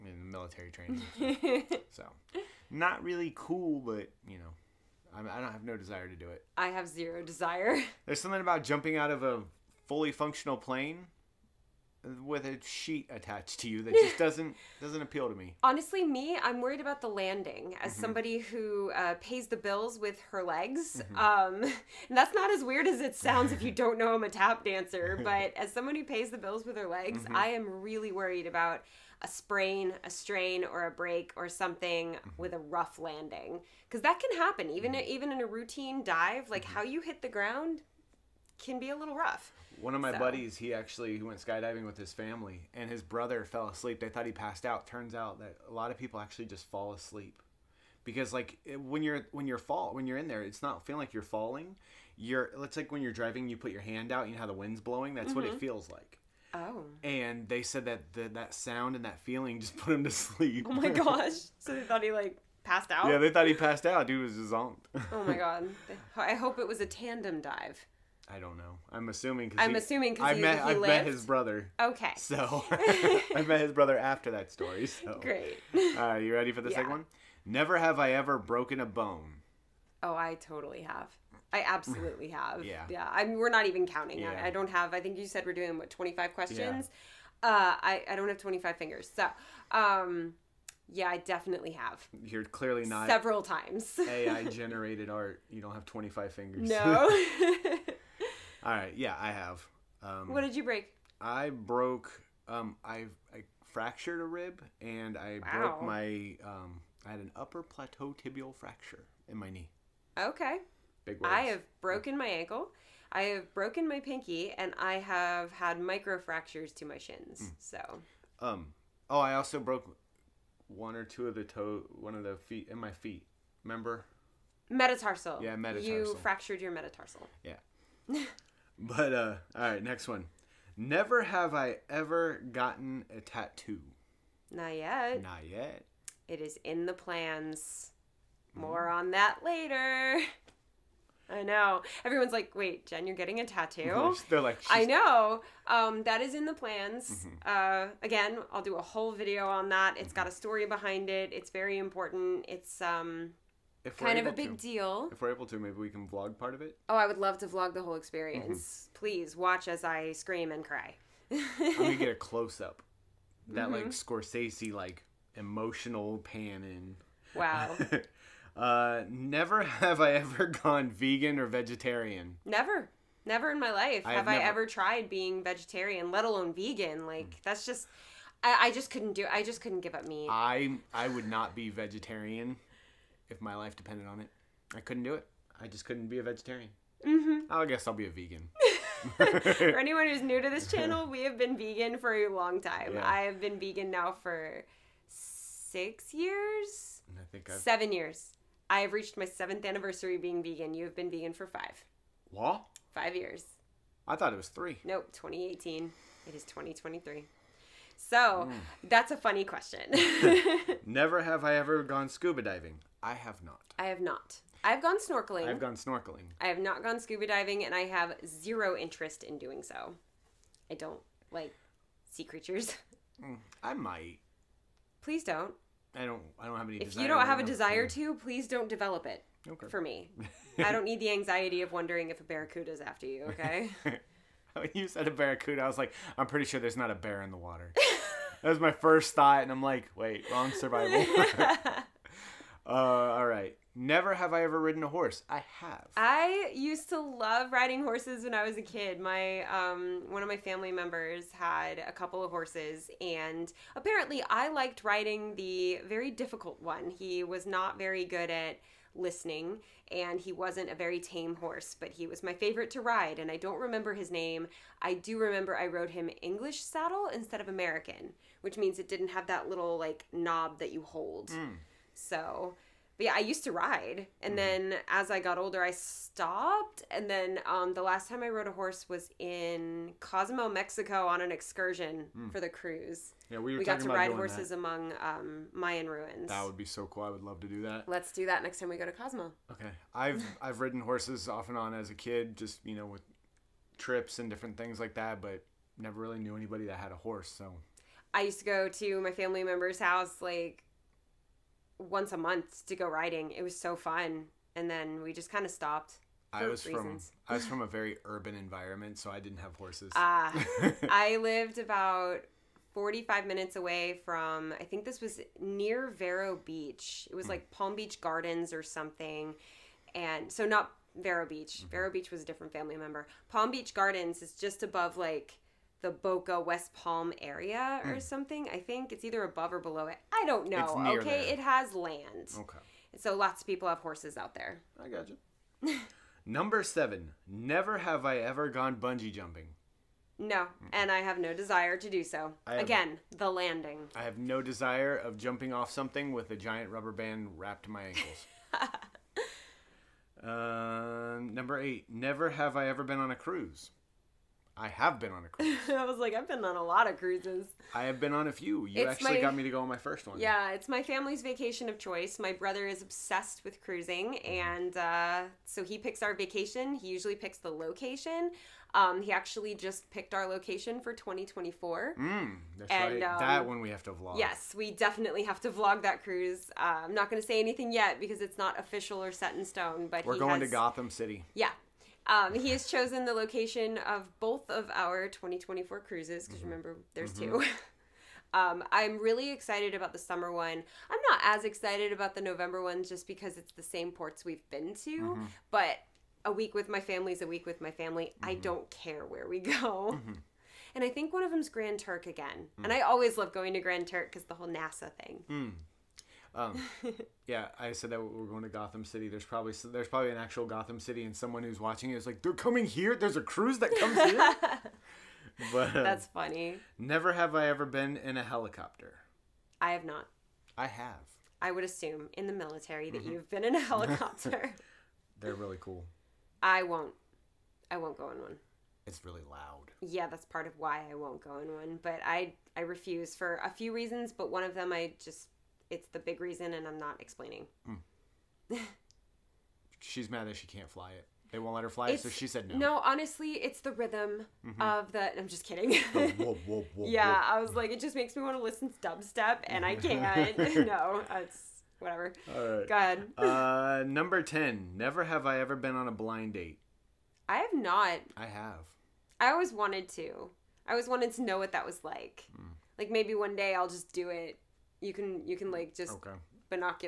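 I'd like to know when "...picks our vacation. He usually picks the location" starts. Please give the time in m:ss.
6:05.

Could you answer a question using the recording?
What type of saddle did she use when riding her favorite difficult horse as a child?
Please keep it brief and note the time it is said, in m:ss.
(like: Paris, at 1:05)
English saddle, at 4:26.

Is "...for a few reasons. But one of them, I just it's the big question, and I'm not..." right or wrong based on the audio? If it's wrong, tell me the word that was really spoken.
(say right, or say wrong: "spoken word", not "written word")
wrong: "reason", not "question".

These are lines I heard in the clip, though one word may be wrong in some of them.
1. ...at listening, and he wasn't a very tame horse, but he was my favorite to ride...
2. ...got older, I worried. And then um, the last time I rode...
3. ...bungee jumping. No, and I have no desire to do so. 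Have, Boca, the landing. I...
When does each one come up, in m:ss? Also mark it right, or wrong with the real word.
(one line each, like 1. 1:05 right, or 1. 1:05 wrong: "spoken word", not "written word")
1. 4:18 right
2. 4:35 wrong: "stopped", not "worried"
3. 5:38 wrong: "Again", not "Boca".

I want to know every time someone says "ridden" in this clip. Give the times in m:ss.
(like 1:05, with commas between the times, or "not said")
4:04, 4:50.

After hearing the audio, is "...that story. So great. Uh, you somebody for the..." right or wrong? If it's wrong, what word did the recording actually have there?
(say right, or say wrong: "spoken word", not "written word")
wrong: "ready", not "somebody".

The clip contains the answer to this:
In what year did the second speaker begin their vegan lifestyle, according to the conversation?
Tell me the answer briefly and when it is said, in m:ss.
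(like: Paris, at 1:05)
2018, at 3:25.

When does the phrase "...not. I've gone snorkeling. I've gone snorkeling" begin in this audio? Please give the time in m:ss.
3:34.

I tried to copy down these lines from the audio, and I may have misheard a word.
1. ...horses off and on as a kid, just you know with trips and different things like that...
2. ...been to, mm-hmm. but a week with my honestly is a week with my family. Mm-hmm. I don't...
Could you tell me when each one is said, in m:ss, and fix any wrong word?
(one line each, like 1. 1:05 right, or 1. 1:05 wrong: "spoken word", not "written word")
1. 4:50 right
2. 6:34 wrong: "family", not "honestly".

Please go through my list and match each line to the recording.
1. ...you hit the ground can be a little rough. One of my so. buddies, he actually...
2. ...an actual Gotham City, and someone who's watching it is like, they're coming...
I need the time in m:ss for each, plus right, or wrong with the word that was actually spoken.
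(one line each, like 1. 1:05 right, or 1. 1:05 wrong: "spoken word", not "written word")
1. 0:36 right
2. 6:50 right.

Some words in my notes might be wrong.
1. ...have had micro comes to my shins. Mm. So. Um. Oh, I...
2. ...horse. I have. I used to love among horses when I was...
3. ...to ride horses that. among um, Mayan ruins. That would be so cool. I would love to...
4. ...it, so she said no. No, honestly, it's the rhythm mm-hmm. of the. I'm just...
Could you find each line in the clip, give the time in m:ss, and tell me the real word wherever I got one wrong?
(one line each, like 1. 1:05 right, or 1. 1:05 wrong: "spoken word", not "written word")
1. 1:54 wrong: "fractures", not "comes"
2. 4:04 wrong: "riding", not "among"
3. 4:43 right
4. 7:21 right.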